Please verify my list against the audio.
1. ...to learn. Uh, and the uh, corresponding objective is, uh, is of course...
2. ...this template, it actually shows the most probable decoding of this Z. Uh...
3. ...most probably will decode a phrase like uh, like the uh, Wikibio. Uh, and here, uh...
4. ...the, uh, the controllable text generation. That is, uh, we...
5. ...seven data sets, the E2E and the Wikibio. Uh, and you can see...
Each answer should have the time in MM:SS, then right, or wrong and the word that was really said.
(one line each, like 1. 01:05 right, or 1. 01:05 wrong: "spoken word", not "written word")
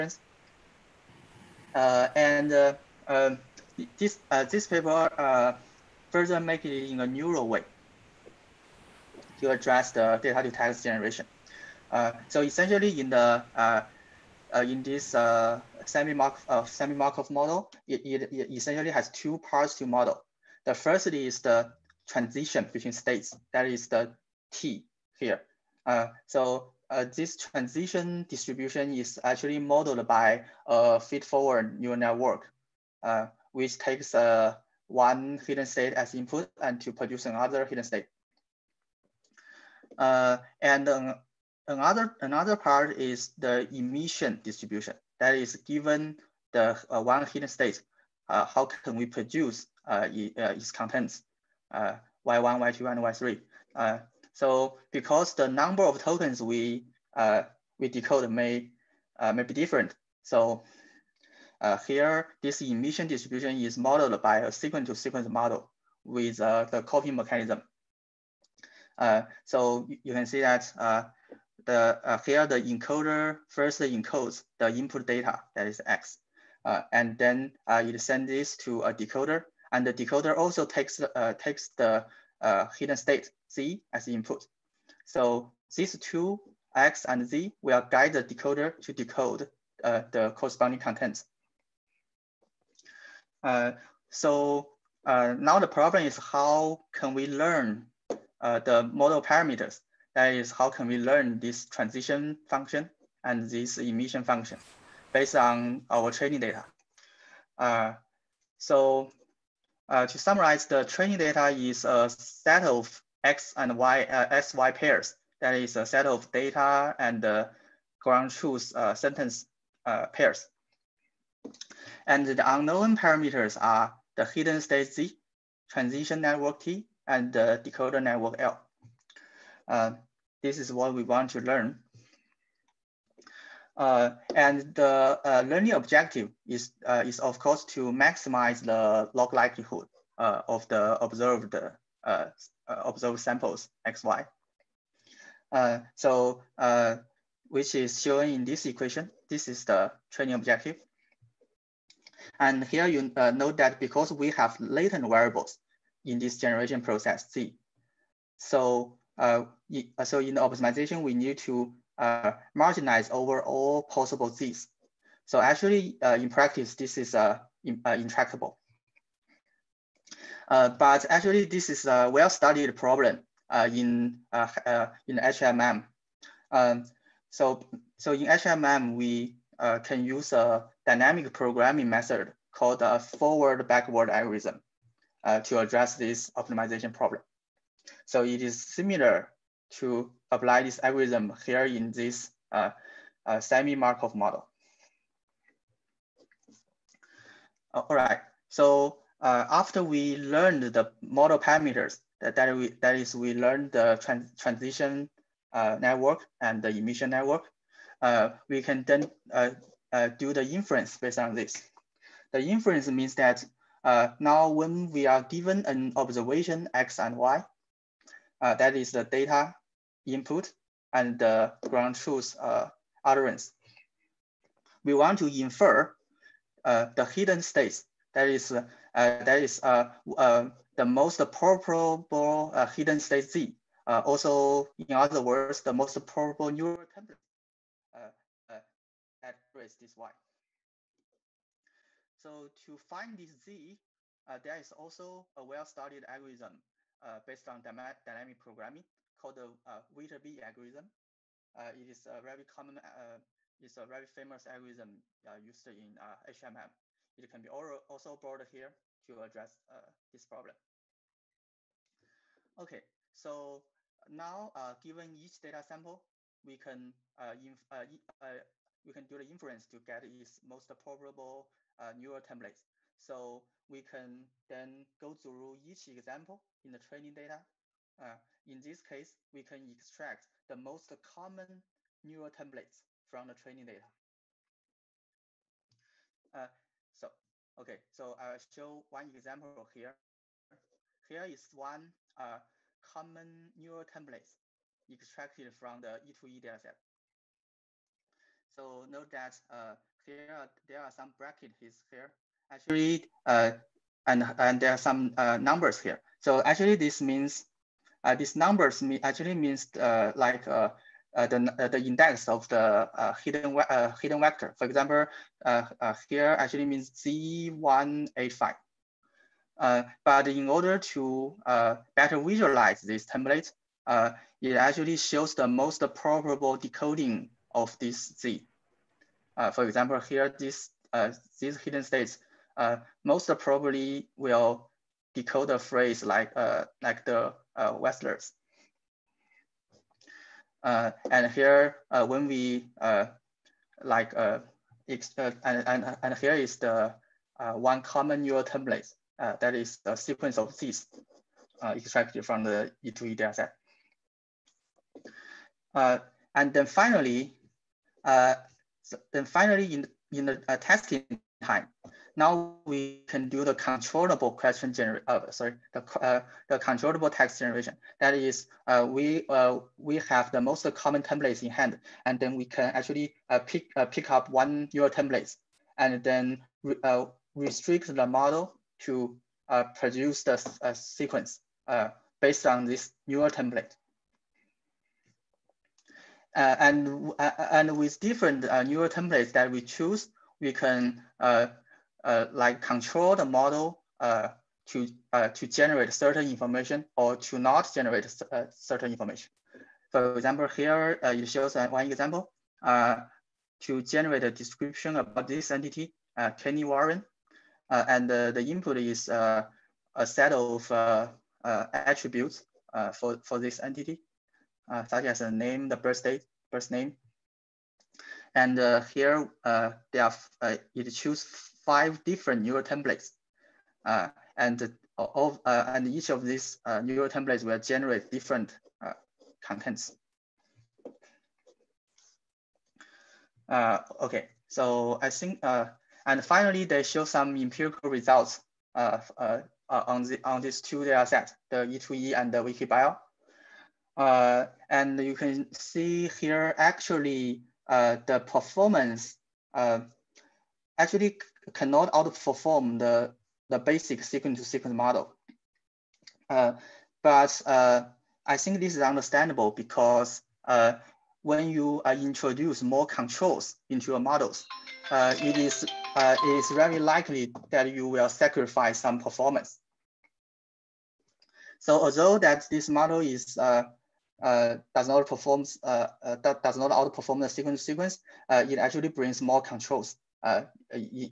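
1. 02:11 wrong: "learning", not "corresponding"
2. 05:22 right
3. 05:33 wrong: "Wrestlers", not "Wikibio"
4. 06:05 right
5. 07:20 wrong: "two", not "seven".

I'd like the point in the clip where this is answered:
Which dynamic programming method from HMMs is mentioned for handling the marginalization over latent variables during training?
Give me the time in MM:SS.
03:02.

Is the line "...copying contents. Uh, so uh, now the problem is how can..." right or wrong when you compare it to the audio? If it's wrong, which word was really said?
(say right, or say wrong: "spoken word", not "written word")
wrong: "corresponding", not "copying".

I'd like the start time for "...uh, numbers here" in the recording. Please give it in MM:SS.
05:05.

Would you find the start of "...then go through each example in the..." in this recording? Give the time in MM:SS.
04:34.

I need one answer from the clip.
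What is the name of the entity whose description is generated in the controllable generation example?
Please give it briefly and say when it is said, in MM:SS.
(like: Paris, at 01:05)
Kenny Warren, at 06:46.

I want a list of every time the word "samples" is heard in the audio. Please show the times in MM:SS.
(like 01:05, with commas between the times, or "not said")
02:23, 04:25.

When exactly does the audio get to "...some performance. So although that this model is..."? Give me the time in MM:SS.
07:48.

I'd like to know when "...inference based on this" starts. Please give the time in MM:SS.
03:30.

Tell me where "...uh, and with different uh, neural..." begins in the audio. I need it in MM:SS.
06:27.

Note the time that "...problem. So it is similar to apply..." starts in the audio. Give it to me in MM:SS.
03:06.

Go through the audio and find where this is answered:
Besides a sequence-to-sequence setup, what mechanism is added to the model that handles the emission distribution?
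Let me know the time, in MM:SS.
01:06.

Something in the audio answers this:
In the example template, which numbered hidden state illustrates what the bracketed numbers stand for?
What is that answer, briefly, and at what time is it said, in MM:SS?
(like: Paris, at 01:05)
Z185, at 05:16.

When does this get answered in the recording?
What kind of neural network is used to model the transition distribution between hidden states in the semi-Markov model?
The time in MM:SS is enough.
00:31.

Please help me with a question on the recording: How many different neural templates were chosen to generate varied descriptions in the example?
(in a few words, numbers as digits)
5.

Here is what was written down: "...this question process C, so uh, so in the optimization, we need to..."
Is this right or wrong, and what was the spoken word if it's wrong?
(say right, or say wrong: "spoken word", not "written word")
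wrong: "generation", not "question".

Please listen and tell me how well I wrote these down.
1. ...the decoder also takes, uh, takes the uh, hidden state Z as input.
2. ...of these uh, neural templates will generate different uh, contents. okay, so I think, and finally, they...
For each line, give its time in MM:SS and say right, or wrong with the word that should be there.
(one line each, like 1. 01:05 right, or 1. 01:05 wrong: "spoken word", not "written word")
1. 01:19 right
2. 07:06 right.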